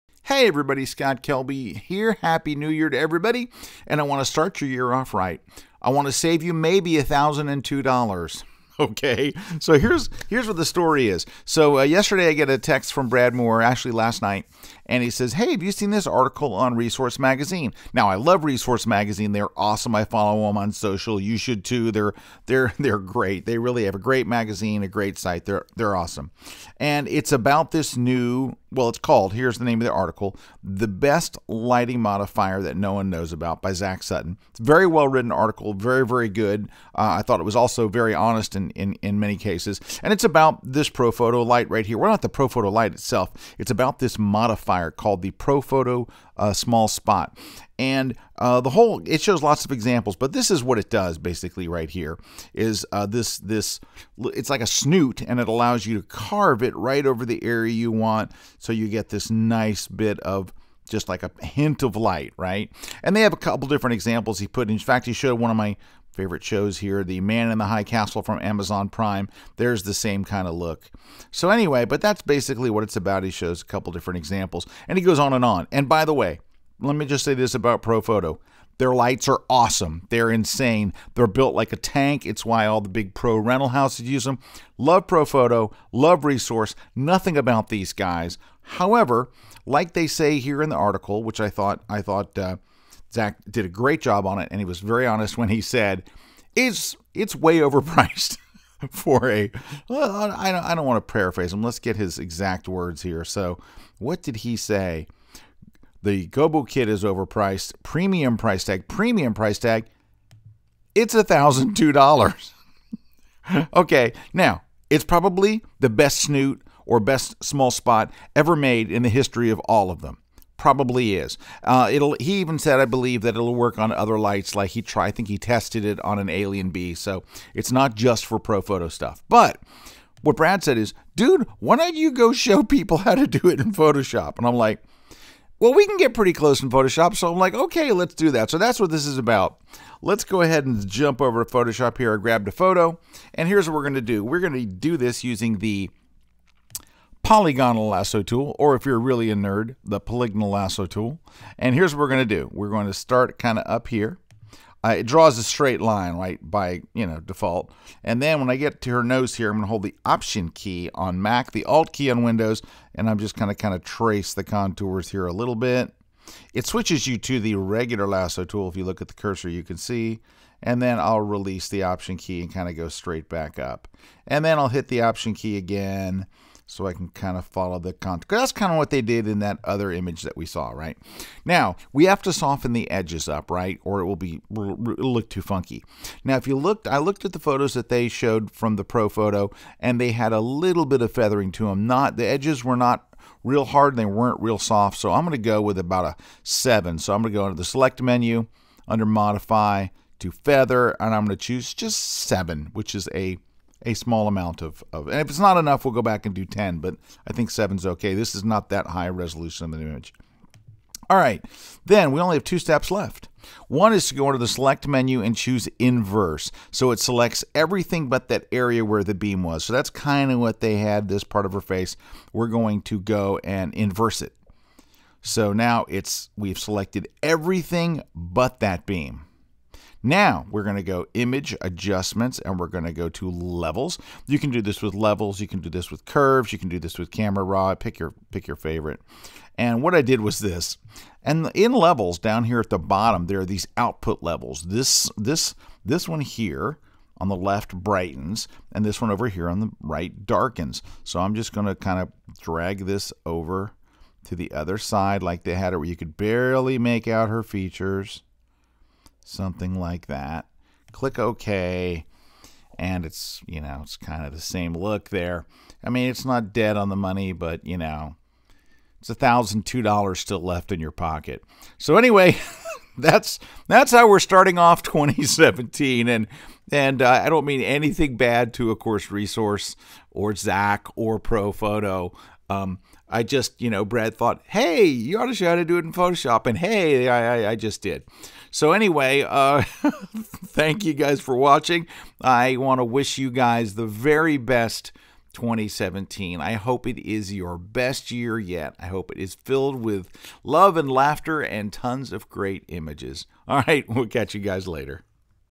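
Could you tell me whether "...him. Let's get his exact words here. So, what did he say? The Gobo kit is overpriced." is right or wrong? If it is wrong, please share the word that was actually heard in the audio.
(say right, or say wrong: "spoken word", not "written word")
right.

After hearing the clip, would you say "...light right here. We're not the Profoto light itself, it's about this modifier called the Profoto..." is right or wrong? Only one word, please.
right.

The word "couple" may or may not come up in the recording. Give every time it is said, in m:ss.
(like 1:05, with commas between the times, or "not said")
1:03, 1:13.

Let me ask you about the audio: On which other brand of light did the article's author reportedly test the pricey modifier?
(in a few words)
AlienBee.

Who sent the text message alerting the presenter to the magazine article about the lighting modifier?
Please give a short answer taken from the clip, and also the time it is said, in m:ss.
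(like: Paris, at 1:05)
Brad Moore, at 0:13.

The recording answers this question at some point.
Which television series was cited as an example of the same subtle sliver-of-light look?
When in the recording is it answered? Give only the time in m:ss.
1:07.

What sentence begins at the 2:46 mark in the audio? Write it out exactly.
It switches you to the regular lasso tool.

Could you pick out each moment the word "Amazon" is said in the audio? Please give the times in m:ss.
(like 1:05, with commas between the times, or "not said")
1:08.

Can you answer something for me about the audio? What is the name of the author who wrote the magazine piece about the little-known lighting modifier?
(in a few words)
Zach Sutton.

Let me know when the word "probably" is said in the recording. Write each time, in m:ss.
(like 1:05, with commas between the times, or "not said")
1:55, 2:00.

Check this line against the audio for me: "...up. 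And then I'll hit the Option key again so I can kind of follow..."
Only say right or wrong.
right.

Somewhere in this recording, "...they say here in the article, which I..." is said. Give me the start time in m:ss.
1:29.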